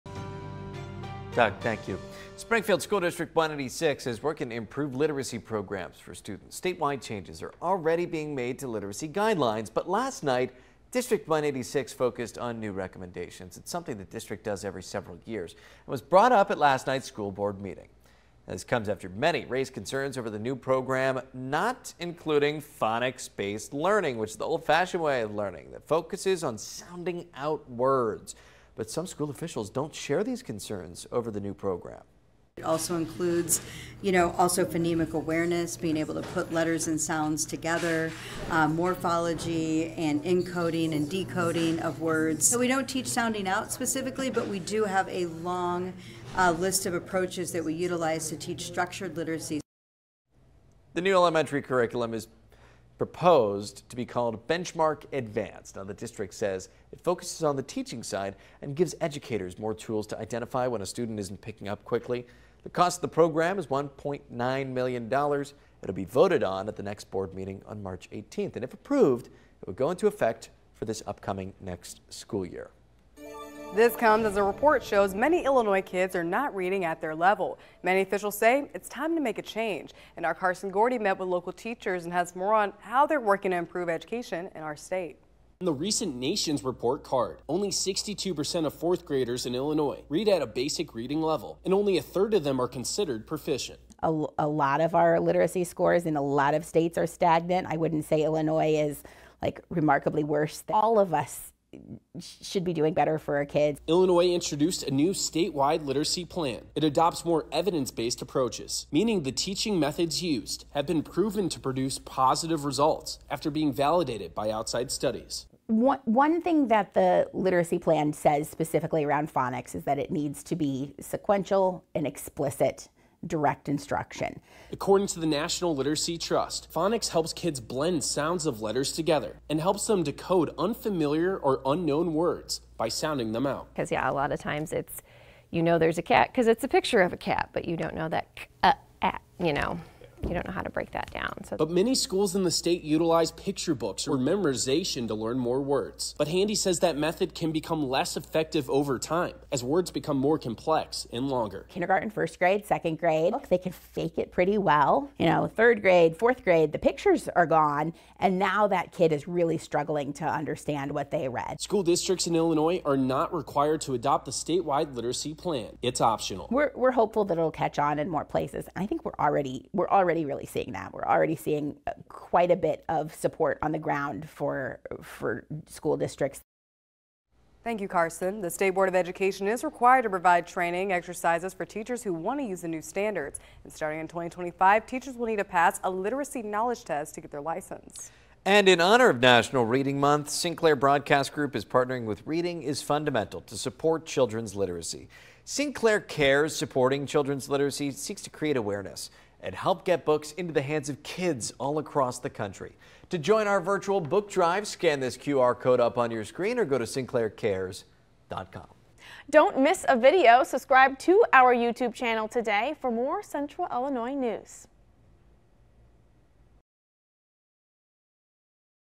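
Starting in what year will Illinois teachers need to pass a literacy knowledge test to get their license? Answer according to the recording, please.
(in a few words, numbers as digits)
2025.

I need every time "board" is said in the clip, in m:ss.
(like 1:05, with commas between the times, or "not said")
0:17, 1:07, 2:58.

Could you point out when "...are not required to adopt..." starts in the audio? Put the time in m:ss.
2:42.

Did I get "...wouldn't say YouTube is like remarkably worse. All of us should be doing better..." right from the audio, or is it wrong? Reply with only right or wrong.
wrong.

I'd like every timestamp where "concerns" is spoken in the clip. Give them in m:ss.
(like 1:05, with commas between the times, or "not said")
0:19, 0:30.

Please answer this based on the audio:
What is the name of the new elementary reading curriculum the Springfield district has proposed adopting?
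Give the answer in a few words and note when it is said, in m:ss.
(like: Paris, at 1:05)
Benchmark Advanced, at 0:54.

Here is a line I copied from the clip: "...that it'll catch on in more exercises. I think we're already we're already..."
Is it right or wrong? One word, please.
wrong.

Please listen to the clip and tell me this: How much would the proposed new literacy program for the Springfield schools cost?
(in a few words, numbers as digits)
$1.9 million.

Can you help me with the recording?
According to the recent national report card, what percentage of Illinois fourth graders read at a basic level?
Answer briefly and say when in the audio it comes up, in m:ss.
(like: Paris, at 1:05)
62%, at 1:27.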